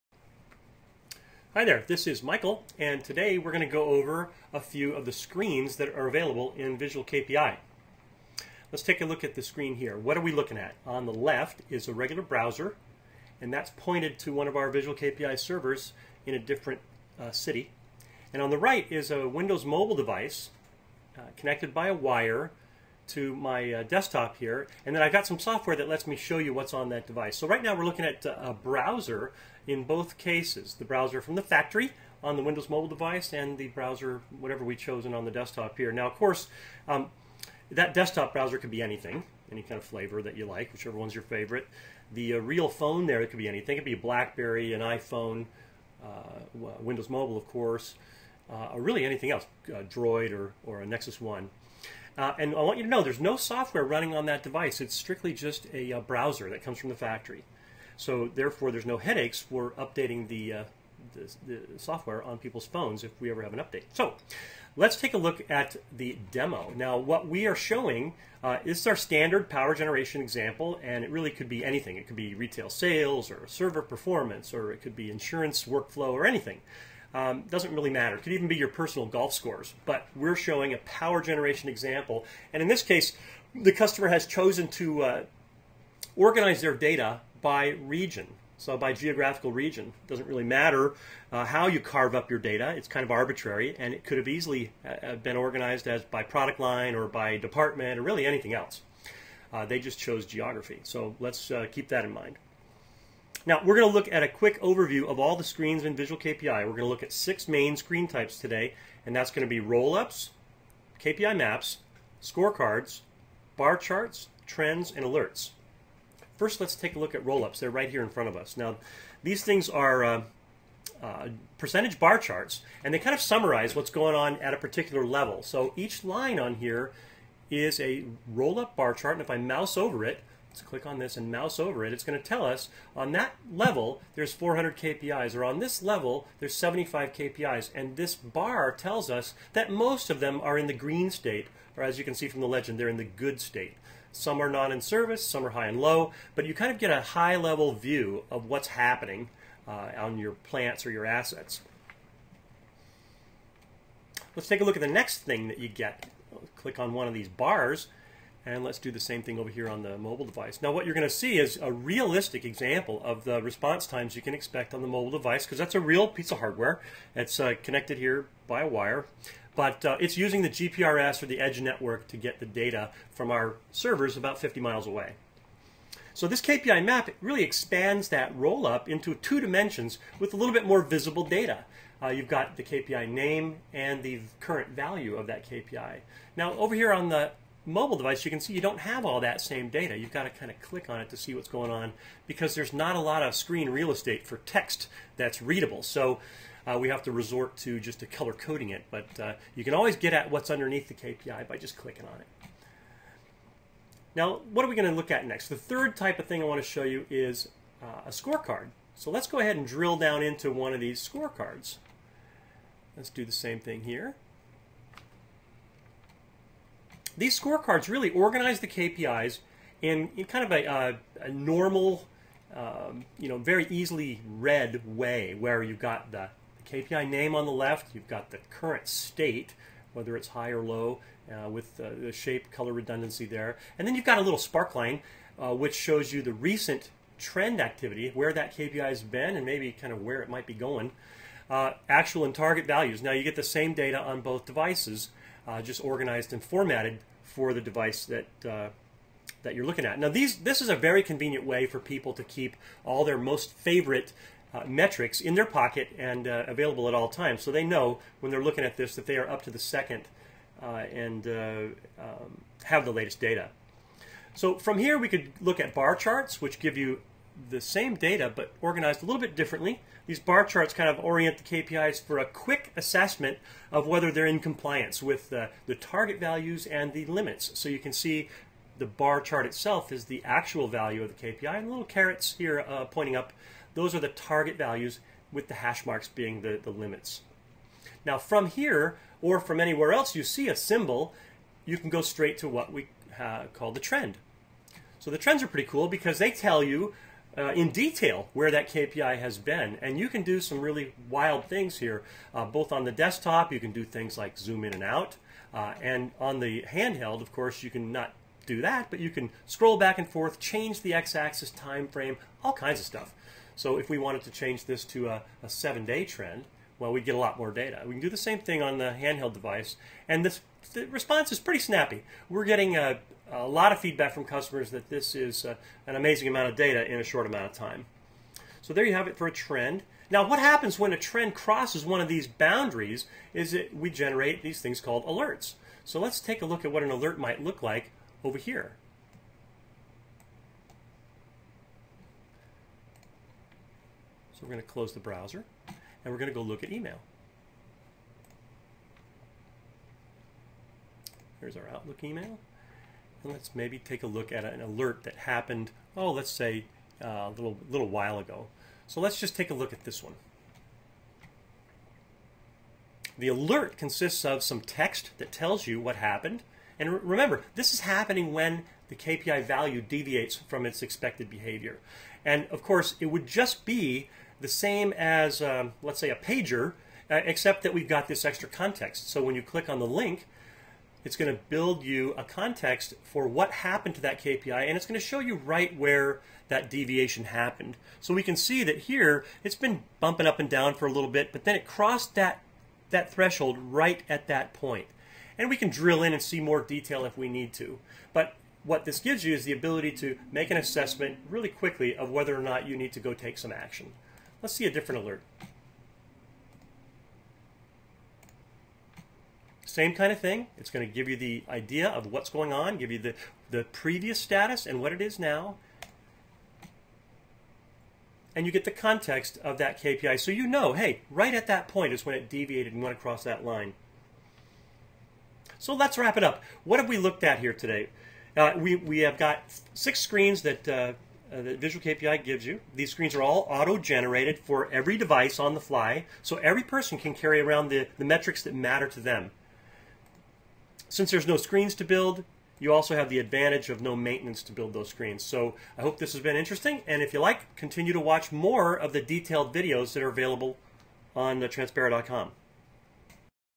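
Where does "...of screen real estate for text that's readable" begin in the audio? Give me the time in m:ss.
3:13.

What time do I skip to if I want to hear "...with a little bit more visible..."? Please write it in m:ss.
3:00.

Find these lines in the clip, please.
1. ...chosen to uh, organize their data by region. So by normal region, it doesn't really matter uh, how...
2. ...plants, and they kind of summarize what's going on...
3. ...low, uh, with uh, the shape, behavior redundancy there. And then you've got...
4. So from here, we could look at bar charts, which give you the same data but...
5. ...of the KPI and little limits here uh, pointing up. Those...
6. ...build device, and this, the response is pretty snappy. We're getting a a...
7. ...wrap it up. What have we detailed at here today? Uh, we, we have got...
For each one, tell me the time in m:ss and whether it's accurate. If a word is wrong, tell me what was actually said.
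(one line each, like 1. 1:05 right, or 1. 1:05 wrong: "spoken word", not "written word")
1. 1:24 wrong: "geographical", not "normal"
2. 2:02 wrong: "charts", not "plants"
3. 3:50 wrong: "color", not "behavior"
4. 4:24 right
5. 4:41 wrong: "carets", not "limits"
6. 5:18 wrong: "handheld", not "build"
7. 7:05 wrong: "looked", not "detailed".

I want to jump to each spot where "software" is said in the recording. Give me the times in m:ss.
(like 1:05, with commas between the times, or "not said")
0:25, 0:53, 1:01.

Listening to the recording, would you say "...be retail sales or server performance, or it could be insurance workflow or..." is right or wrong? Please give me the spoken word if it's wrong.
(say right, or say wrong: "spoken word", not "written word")
right.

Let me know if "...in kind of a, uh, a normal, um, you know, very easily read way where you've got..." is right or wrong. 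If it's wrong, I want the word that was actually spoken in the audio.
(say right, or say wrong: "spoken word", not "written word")
right.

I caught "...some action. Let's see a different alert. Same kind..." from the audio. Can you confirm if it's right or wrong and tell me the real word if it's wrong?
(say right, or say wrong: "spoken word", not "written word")
right.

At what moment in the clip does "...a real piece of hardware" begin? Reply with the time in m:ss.
2:45.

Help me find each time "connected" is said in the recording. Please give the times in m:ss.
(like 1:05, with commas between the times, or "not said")
0:21, 2:47.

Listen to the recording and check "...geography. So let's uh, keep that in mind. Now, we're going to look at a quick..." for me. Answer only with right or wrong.
right.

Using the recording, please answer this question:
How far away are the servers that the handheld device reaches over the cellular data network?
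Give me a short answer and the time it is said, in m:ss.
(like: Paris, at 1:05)
50 miles, at 2:54.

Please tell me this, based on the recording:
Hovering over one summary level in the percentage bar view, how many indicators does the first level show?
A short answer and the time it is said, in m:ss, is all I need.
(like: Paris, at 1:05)
400, at 2:14.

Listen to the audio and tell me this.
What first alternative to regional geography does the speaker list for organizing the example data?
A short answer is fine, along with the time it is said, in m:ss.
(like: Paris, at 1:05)
product line, at 1:36.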